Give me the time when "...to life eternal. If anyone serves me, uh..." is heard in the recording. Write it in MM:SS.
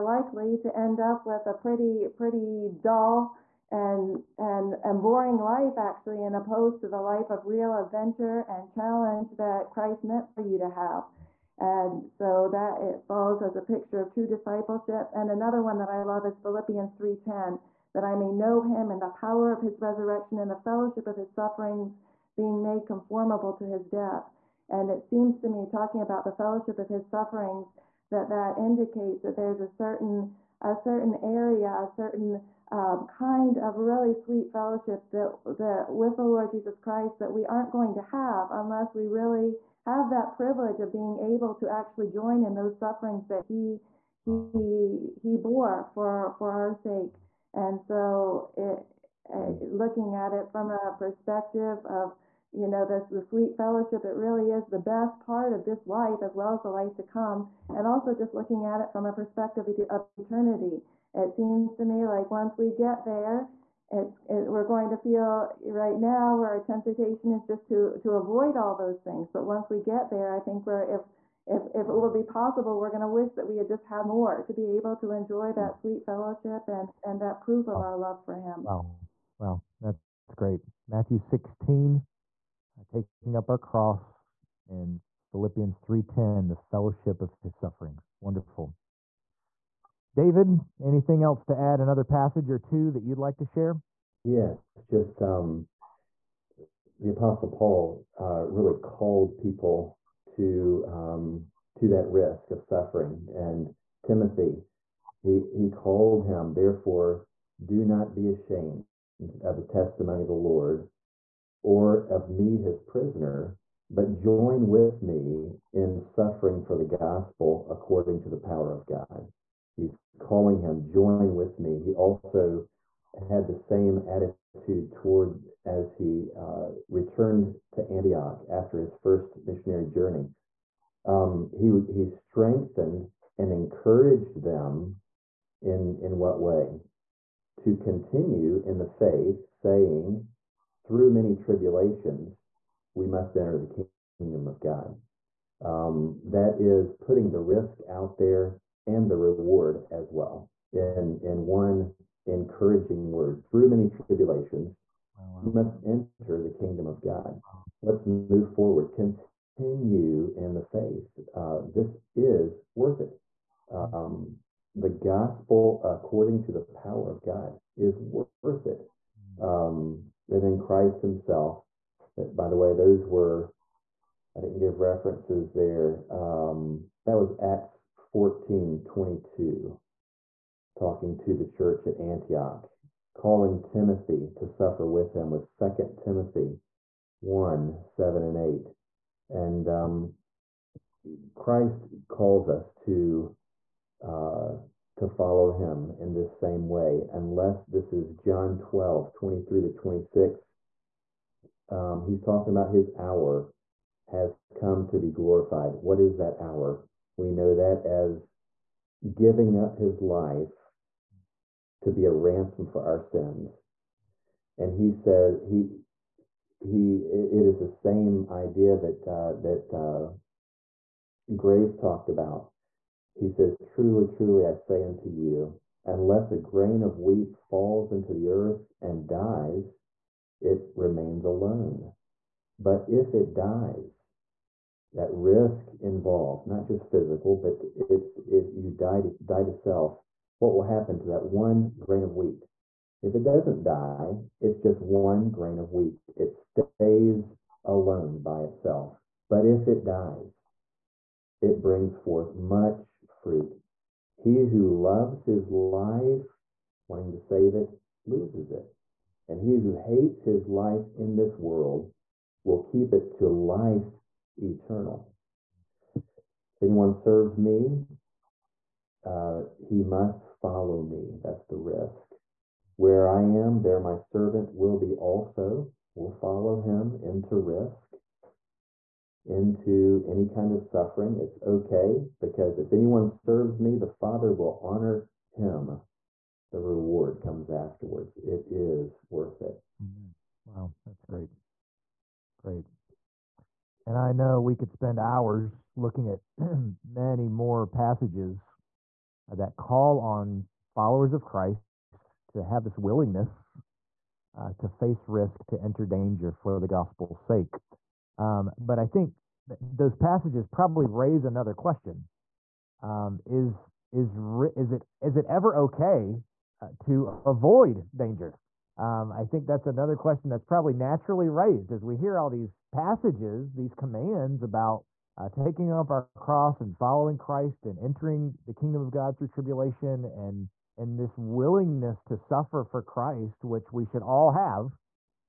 04:23.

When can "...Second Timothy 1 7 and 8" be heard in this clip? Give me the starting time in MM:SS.
03:05.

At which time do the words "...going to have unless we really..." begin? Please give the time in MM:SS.
00:37.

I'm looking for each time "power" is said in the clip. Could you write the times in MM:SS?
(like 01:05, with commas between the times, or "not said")
00:19, 01:58, 02:46.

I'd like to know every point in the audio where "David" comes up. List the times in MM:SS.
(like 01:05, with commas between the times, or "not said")
01:30.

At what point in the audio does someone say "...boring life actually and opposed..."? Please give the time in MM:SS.
00:05.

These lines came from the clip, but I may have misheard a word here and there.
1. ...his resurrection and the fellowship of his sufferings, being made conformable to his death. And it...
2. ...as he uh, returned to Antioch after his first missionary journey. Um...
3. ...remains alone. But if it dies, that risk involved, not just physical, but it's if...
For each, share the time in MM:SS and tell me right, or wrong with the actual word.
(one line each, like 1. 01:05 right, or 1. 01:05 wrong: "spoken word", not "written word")
1. 00:19 right
2. 02:05 right
3. 03:50 right.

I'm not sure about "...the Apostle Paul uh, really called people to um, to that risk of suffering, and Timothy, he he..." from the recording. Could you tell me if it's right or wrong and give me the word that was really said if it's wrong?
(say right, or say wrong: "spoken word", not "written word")
right.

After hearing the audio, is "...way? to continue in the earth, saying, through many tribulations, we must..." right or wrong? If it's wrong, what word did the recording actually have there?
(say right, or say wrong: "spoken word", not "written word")
wrong: "faith", not "earth".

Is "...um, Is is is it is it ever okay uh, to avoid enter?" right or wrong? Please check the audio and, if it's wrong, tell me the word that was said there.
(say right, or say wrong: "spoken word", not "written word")
wrong: "danger", not "enter".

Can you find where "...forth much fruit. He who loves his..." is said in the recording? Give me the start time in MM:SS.
04:11.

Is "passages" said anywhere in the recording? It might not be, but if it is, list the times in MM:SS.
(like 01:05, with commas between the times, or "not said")
01:32, 04:57, 05:09, 05:22.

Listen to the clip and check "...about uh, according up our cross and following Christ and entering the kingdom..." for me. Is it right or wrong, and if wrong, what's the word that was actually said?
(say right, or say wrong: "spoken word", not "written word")
wrong: "taking", not "according".